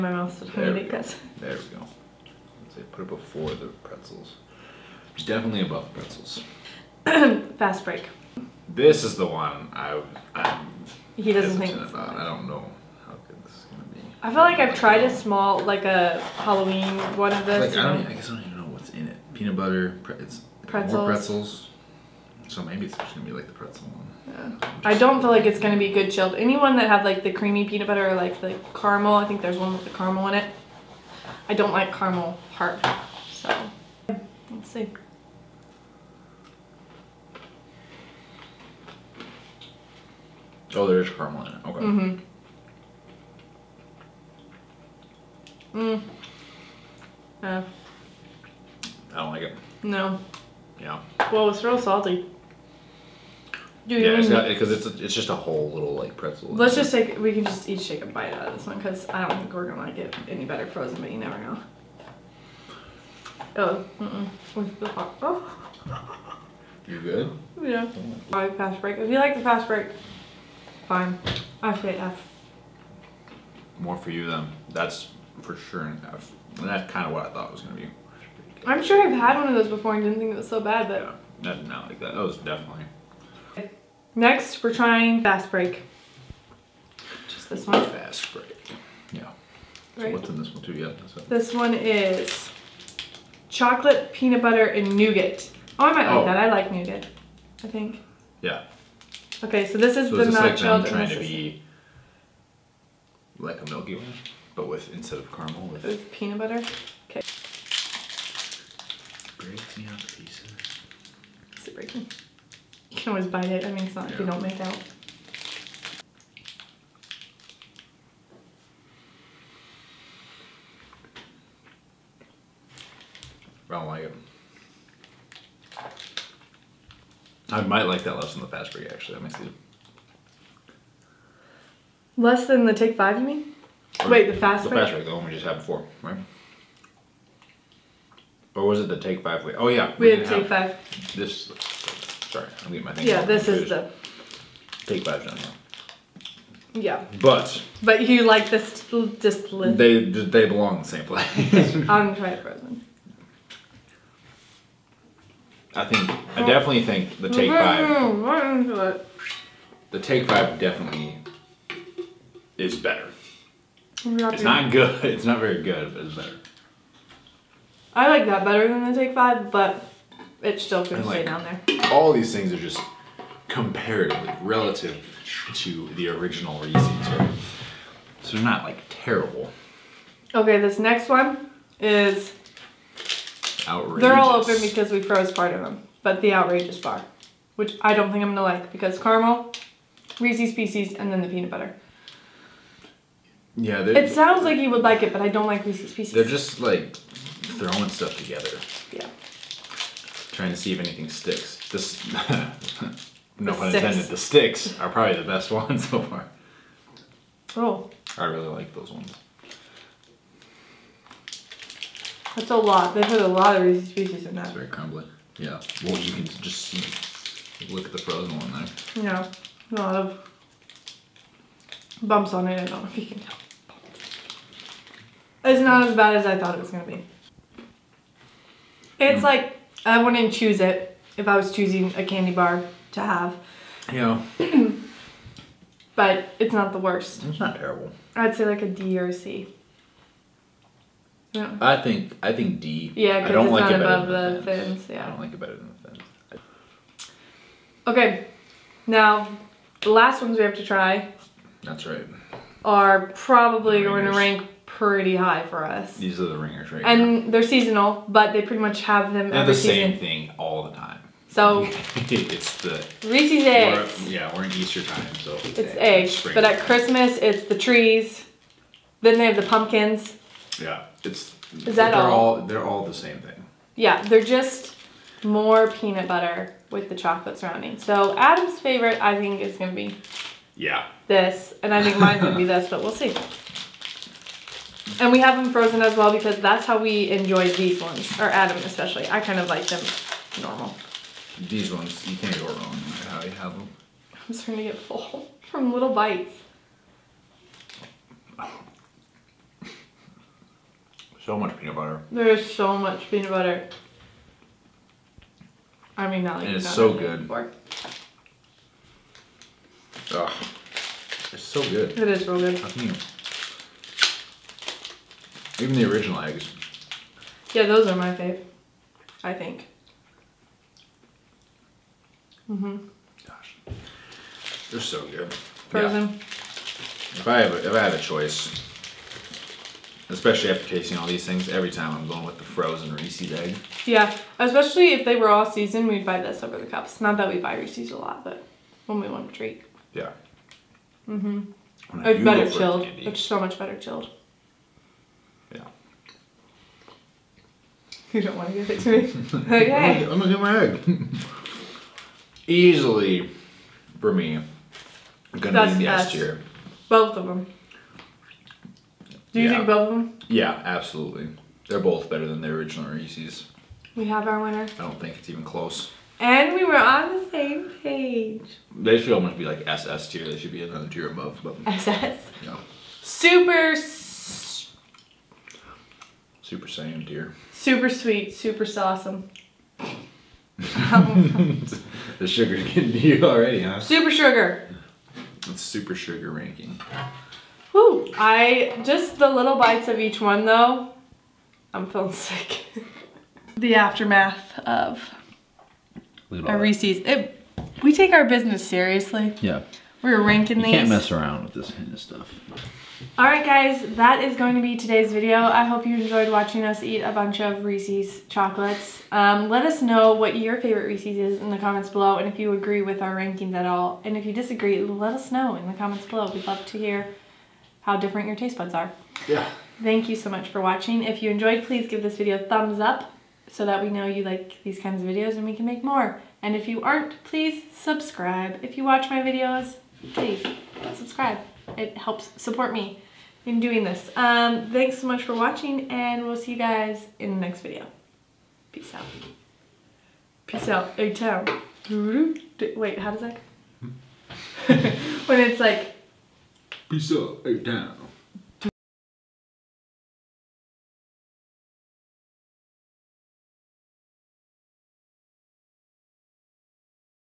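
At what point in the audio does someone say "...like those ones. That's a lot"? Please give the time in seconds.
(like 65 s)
208 s.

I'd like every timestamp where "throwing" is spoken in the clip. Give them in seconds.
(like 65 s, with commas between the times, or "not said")
196 s.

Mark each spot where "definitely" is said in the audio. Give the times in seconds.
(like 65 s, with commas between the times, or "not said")
5 s, 82 s, 156 s, 160 s.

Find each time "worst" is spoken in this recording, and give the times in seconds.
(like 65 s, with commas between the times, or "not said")
236 s.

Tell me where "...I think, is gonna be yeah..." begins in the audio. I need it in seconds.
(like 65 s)
279 s.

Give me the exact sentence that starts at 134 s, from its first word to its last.
Or Wait, the fast the break?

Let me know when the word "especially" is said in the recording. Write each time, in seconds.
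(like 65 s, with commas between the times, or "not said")
288 s, 330 s, 334 s.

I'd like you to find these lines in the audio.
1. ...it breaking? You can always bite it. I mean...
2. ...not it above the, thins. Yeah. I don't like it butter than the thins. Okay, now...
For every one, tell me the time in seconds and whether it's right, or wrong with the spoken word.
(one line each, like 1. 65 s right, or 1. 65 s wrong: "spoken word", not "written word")
1. 111 s right
2. 243 s wrong: "better", not "butter".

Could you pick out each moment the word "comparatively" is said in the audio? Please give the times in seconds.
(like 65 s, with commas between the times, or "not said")
173 s.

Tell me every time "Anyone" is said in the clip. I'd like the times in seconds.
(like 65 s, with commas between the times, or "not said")
26 s.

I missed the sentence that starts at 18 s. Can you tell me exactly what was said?
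I guess I don't even know what's in it.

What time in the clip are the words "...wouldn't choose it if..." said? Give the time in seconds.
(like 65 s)
230 s.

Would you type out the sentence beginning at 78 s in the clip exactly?
I'm sure I've had one of those before and didn't think it was so bad, but...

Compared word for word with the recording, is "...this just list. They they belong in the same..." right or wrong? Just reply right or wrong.
right.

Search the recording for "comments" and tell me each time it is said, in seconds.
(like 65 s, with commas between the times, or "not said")
411 s, 415 s.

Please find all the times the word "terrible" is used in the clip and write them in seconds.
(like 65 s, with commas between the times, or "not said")
178 s, 237 s.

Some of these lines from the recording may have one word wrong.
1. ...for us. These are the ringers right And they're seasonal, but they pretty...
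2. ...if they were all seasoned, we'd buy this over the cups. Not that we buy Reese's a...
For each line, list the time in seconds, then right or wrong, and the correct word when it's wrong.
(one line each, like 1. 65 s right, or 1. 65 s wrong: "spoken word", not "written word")
1. 255 s right
2. 334 s right.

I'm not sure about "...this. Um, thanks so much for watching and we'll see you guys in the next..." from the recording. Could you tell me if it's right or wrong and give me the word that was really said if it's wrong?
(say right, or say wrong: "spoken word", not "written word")
right.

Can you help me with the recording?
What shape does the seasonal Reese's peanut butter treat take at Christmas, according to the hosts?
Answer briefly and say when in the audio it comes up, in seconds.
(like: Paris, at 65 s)
trees, at 267 s.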